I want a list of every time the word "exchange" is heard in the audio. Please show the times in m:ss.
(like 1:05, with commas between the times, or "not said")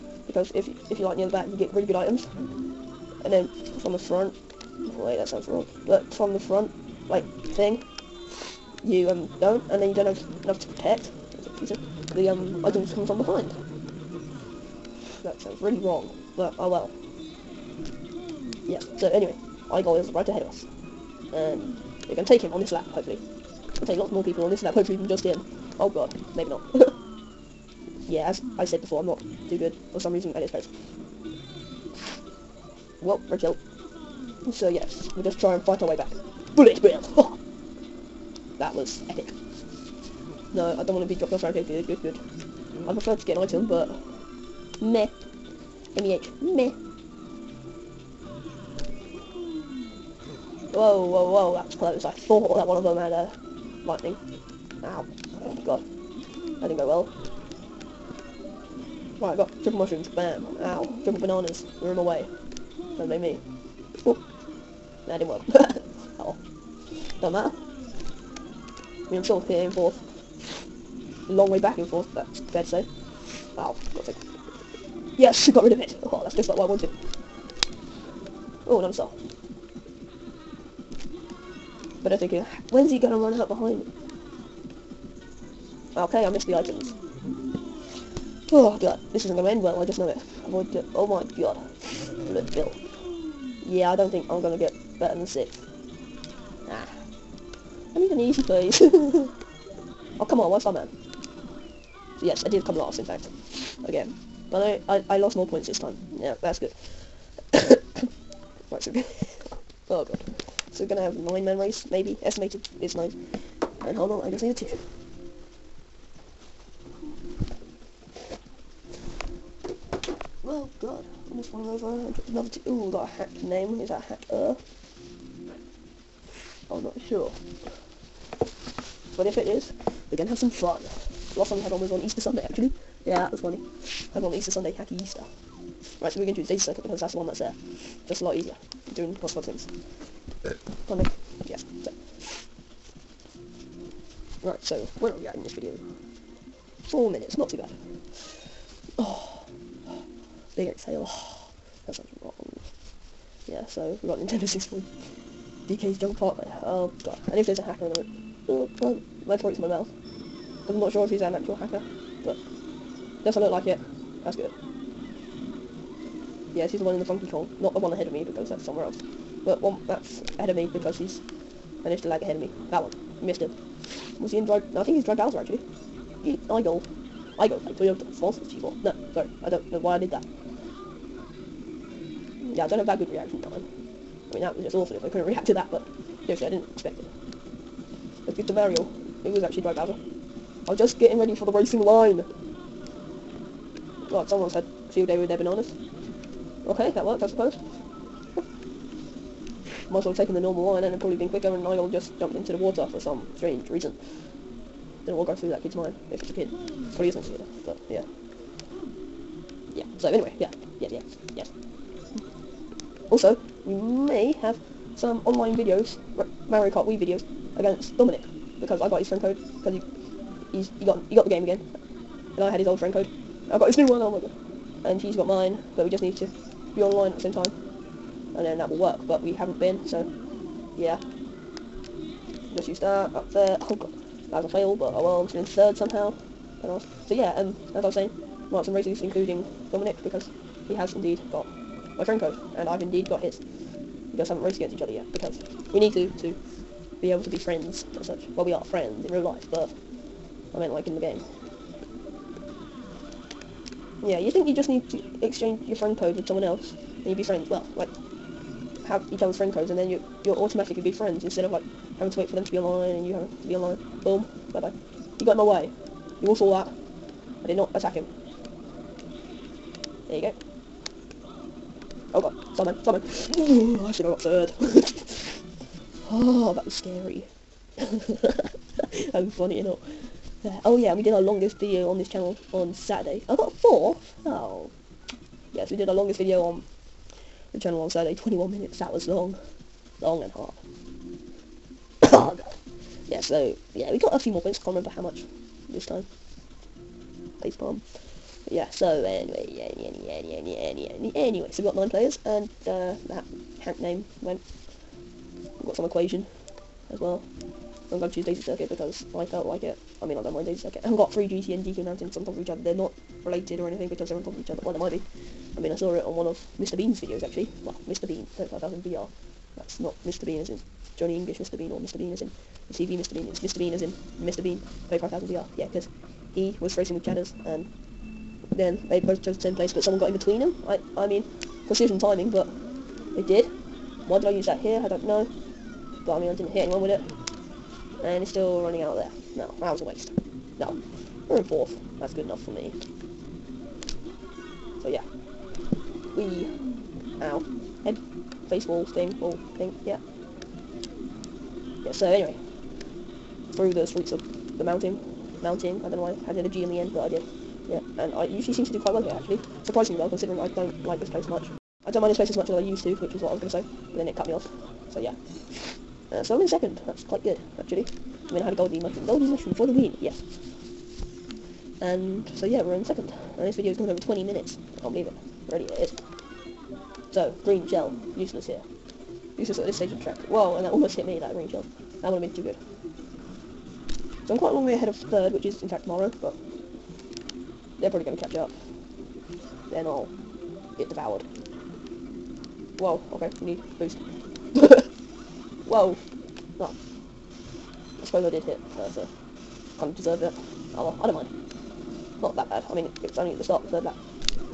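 4:15.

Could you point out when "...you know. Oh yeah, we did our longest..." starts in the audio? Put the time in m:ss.
4:39.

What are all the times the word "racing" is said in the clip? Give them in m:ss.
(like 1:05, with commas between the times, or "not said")
3:11, 5:26.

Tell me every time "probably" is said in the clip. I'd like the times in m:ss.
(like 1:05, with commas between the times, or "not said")
3:20, 3:26, 6:27.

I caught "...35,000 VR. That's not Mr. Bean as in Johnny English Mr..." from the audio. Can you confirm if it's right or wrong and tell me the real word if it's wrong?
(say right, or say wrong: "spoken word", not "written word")
right.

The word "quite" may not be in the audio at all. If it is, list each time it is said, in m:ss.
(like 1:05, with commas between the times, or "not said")
5:58, 6:07, 6:24.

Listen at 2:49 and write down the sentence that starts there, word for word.
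But one that's ahead of me because he's managed to lag ahead of me.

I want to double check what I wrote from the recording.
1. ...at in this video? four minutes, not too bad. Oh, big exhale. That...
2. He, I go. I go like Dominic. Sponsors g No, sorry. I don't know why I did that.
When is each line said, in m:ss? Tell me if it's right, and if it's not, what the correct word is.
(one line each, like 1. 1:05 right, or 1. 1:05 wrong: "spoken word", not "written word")
1. 2:25 right
2. 2:56 wrong: "Toyota", not "Dominic".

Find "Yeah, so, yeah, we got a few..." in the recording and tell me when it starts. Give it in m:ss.
4:53.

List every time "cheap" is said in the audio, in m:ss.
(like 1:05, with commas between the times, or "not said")
not said.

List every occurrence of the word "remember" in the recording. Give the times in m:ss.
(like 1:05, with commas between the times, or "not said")
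4:54.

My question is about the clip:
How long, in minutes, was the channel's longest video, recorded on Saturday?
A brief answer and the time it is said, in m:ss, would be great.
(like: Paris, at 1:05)
21, at 4:48.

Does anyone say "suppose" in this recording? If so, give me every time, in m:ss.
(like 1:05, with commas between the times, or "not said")
3:17, 6:38.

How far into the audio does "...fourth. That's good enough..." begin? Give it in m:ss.
5:41.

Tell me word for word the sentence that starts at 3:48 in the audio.
And then that will work, but we haven't been, so yeah.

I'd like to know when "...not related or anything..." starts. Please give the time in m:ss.
5:12.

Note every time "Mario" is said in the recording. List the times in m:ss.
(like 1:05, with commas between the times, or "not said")
3:08, 3:36.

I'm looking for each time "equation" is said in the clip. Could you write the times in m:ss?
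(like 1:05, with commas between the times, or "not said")
5:05.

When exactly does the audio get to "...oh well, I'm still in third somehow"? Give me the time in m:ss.
3:54.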